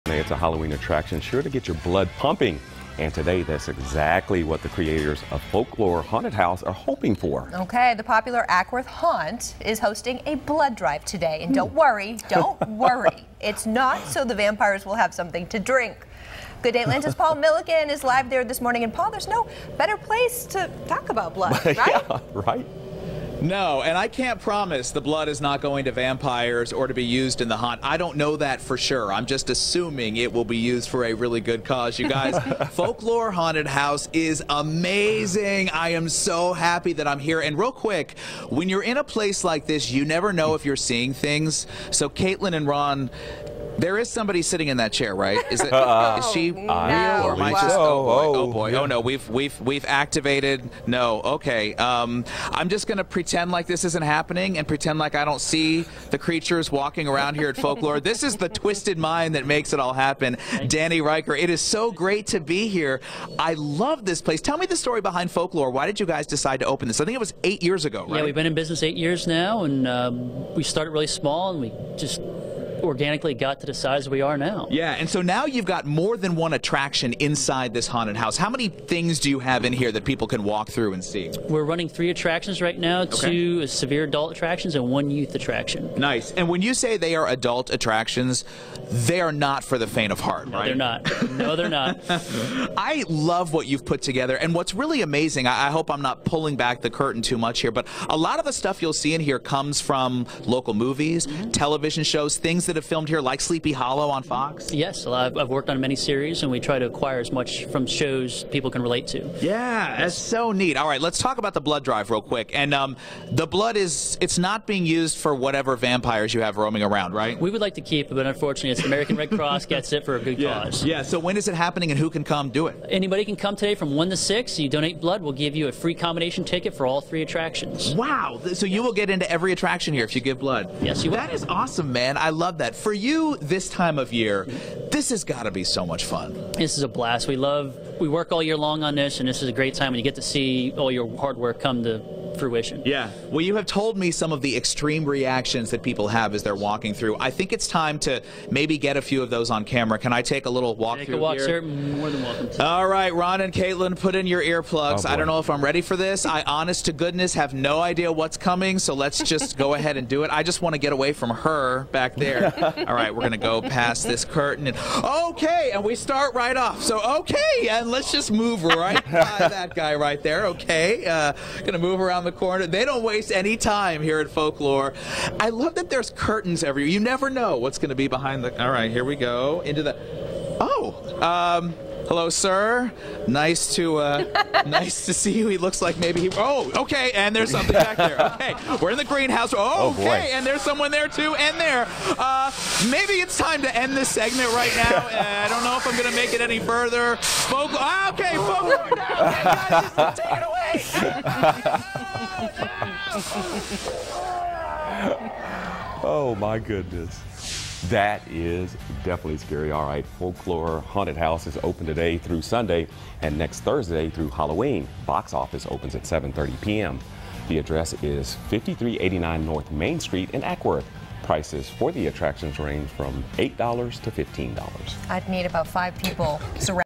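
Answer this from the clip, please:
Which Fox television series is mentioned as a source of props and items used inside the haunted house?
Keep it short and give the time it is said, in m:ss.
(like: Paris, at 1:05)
Sleepy Hollow, at 1:43.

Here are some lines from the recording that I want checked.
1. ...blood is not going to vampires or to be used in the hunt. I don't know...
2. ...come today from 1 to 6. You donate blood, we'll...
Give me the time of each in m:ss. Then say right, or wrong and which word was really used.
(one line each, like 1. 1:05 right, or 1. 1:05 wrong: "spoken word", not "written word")
1. 0:25 right
2. 2:03 right.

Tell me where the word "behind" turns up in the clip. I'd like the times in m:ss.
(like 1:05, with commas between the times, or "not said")
1:05, 2:58.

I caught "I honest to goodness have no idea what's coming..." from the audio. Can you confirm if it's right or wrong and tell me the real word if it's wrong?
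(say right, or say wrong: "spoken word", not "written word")
right.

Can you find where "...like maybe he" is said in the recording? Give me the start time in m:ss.
3:05.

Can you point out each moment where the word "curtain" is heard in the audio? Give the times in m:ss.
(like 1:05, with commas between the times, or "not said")
1:36, 2:44, 2:56.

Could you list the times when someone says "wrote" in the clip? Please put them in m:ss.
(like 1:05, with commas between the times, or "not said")
not said.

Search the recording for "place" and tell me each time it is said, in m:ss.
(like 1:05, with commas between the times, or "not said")
0:19, 0:39, 1:04.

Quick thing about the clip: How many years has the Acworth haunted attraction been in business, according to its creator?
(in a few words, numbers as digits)
8.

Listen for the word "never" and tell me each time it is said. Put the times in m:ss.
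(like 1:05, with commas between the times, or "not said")
0:40, 2:56.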